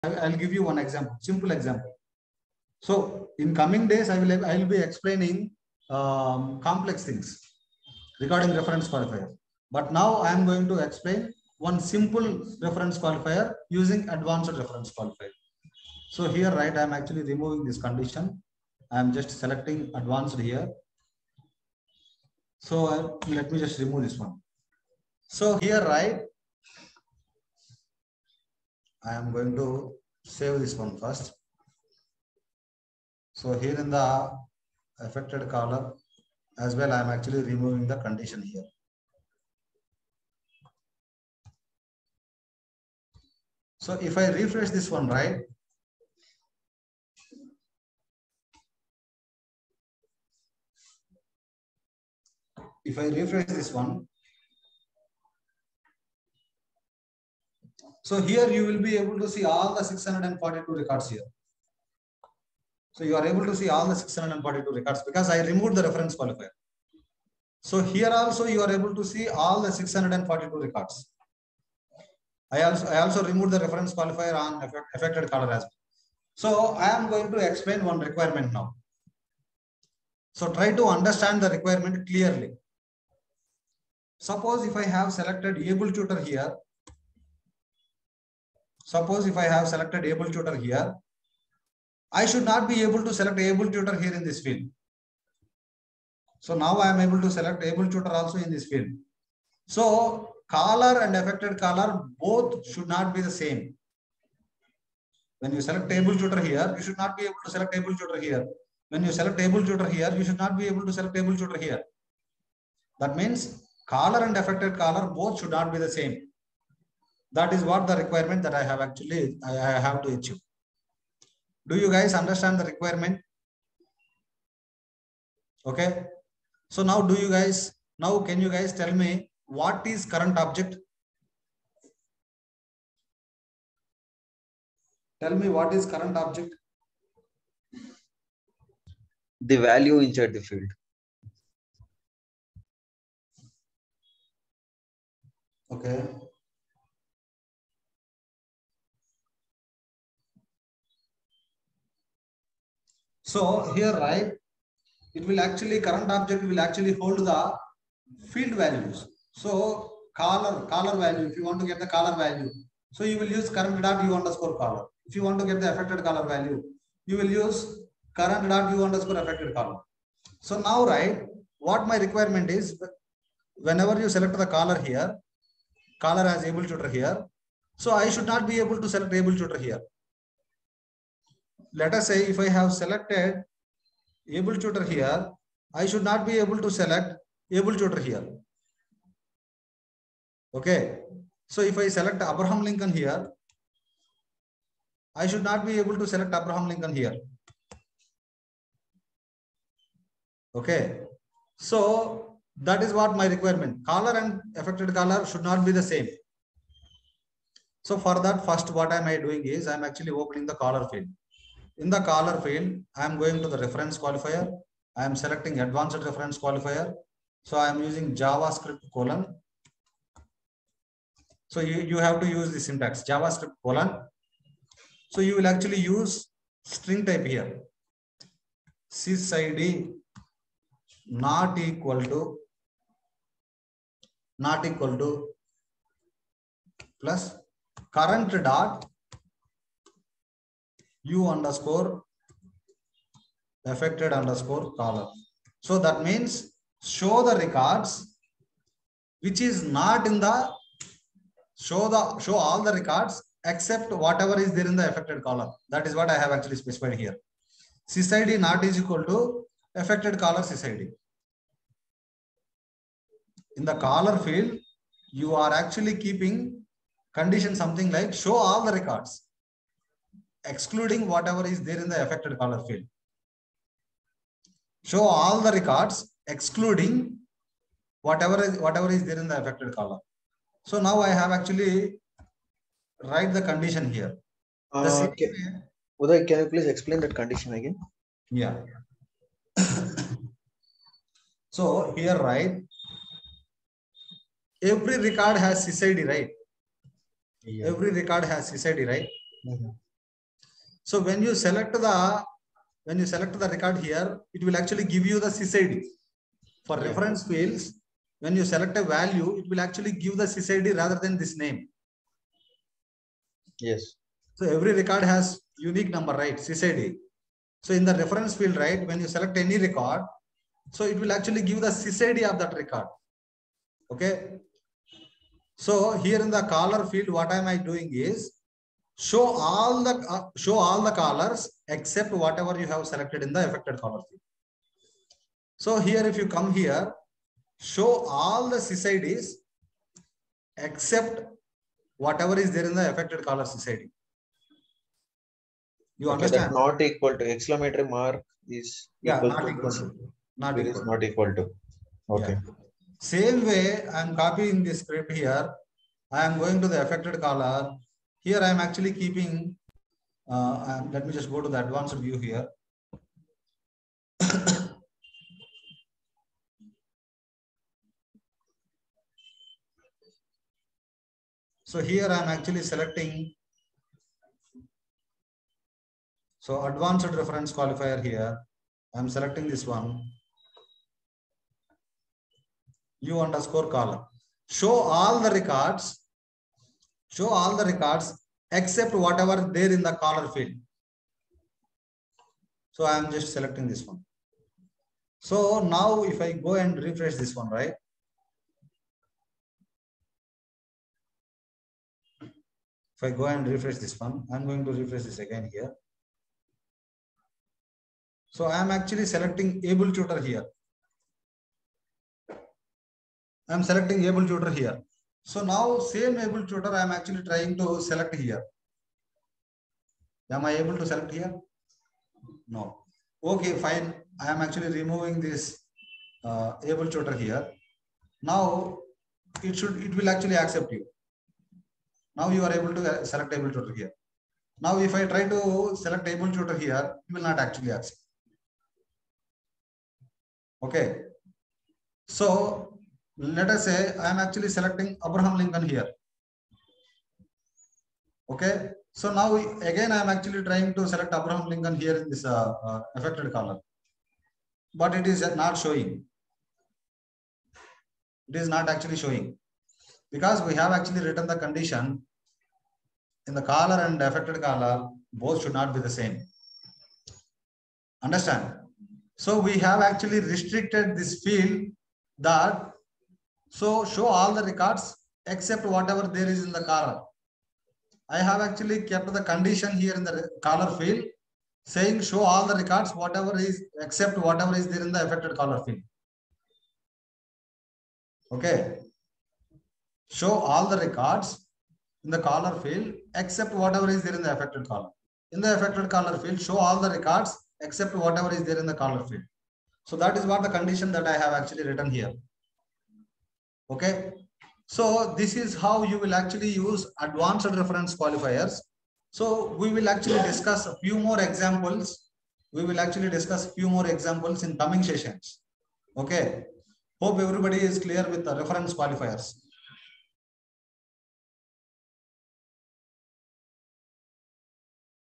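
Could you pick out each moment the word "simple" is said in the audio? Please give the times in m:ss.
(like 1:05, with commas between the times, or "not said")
0:01, 0:11.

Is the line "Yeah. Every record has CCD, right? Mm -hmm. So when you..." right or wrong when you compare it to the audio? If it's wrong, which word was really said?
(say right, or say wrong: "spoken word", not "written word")
right.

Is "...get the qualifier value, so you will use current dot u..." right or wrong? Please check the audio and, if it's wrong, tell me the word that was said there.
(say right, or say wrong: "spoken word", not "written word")
wrong: "caller", not "qualifier".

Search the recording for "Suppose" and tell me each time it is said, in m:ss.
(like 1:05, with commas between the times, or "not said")
1:24, 1:28.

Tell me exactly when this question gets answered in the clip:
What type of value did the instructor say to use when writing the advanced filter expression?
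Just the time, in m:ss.
3:46.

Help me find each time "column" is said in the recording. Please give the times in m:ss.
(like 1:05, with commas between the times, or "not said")
0:35, 4:15, 6:23.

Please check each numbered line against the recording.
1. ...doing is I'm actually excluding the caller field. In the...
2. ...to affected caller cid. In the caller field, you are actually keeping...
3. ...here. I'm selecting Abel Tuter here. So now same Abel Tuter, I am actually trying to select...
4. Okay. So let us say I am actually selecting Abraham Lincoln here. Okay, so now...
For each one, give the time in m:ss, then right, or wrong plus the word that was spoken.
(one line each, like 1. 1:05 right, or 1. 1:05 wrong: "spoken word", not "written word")
1. 3:29 wrong: "opening", not "excluding"
2. 4:19 right
3. 6:50 right
4. 7:20 right.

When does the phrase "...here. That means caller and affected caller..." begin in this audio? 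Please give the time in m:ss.
1:51.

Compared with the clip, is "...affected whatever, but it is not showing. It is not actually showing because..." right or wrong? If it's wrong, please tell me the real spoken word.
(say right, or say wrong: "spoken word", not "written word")
wrong: "caller", not "whatever".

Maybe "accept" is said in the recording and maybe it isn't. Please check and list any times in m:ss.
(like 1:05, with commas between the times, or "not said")
7:10, 7:17.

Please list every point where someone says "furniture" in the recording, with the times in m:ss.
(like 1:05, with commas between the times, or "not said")
not said.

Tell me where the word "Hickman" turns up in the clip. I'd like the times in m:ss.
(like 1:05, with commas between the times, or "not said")
not said.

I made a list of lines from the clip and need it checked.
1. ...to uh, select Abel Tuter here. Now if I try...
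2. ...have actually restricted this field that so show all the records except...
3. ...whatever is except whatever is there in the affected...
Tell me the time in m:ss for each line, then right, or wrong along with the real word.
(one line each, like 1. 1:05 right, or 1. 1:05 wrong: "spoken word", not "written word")
1. 7:12 right
2. 7:49 right
3. 8:02 right.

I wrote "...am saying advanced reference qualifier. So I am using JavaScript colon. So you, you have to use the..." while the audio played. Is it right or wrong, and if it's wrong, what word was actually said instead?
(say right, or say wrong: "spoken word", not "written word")
wrong: "selecting", not "saying".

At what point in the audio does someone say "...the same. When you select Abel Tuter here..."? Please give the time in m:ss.
1:43.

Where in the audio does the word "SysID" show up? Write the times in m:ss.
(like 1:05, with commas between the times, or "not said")
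3:48, 5:05, 5:10, 5:16, 5:21.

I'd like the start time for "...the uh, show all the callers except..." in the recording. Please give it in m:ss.
5:29.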